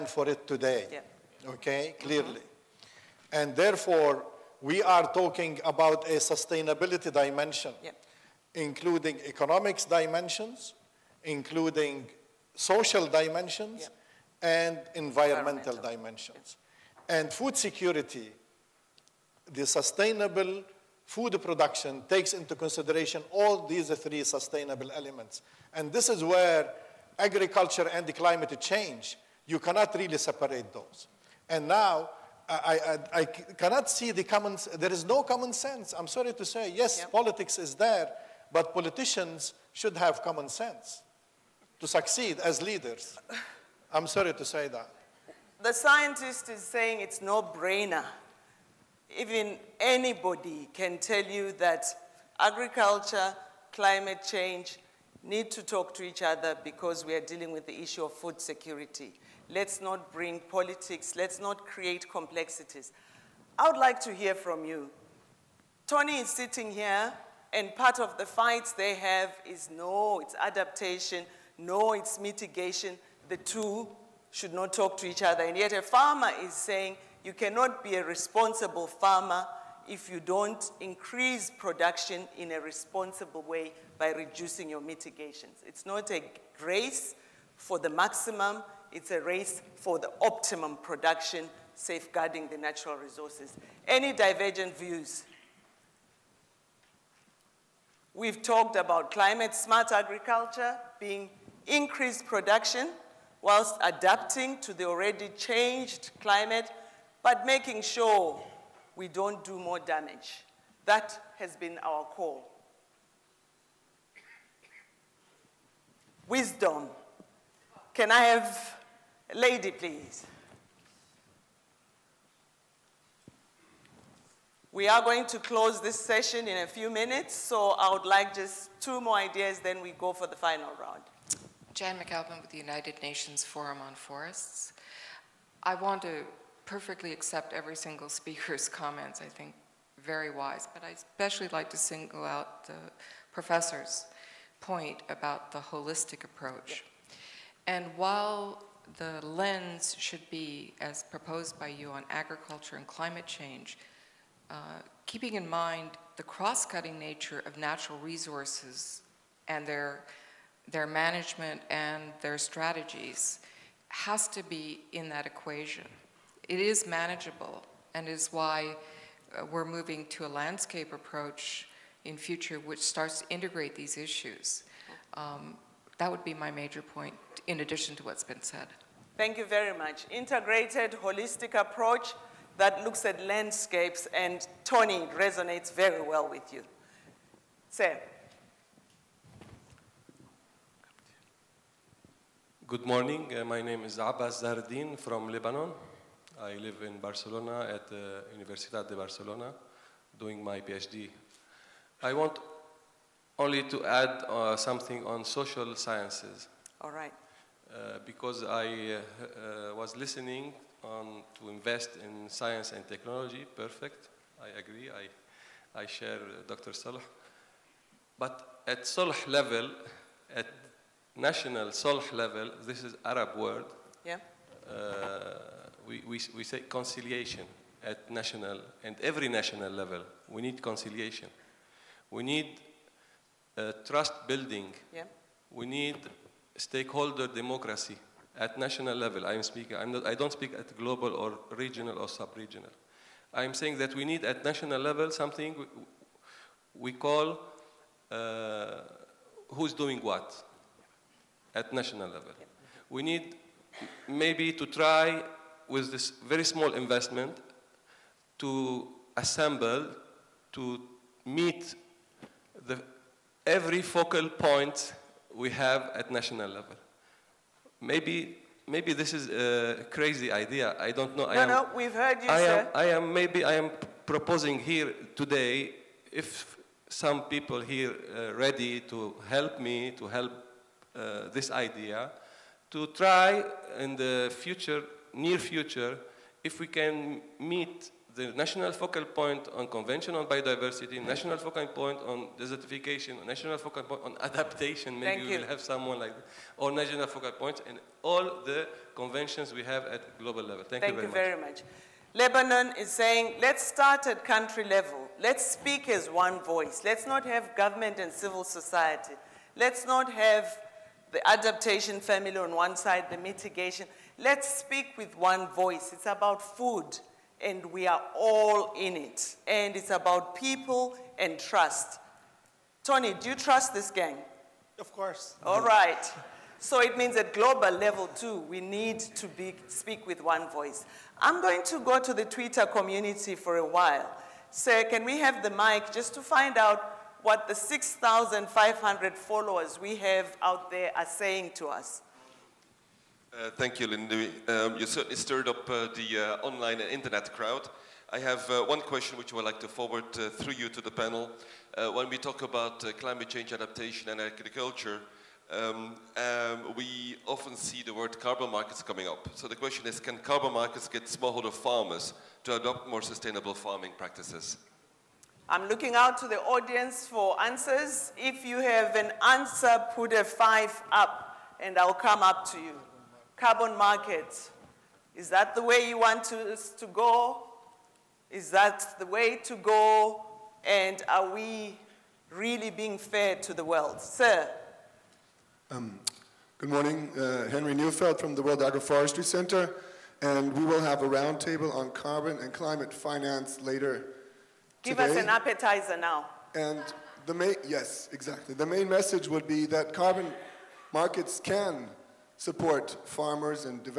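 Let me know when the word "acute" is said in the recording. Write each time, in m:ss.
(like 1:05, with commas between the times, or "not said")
not said.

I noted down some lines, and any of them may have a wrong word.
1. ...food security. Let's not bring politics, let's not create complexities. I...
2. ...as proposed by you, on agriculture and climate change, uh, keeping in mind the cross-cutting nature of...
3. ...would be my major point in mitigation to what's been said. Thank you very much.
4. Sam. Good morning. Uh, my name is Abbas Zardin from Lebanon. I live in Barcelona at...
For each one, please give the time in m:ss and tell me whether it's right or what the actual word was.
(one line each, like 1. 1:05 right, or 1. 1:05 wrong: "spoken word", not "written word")
1. 0:58 right
2. 2:30 right
3. 2:56 wrong: "addition", not "mitigation"
4. 3:07 right.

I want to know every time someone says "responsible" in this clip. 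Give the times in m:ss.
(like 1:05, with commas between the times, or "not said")
1:18, 1:22.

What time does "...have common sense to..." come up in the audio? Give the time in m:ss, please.
0:39.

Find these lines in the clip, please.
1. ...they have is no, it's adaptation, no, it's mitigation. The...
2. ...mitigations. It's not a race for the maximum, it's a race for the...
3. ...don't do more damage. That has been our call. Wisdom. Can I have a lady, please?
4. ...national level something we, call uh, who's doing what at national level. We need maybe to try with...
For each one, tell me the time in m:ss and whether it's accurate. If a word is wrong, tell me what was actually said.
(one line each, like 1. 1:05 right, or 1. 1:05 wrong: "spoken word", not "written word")
1. 1:08 right
2. 1:24 right
3. 1:49 right
4. 4:04 right.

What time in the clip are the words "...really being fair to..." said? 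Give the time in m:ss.
6:22.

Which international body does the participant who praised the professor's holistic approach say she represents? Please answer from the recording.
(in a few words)
United Nations Forum on Forests.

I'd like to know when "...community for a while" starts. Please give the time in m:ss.
5:32.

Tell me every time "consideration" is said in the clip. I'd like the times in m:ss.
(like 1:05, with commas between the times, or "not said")
0:22.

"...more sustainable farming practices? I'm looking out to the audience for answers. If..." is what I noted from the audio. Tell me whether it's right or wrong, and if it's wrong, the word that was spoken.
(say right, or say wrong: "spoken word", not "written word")
right.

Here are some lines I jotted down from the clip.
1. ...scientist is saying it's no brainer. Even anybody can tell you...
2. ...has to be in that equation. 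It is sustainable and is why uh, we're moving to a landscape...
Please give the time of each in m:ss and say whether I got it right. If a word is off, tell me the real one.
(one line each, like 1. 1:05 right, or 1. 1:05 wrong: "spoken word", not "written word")
1. 0:45 right
2. 2:43 wrong: "manageable", not "sustainable".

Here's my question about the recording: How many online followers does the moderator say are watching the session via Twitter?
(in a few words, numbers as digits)
6,500.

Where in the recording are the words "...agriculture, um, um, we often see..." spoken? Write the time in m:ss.
5:54.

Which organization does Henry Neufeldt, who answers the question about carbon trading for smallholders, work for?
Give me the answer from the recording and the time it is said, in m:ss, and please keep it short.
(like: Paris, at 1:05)
World Agroforestry Center, at 6:28.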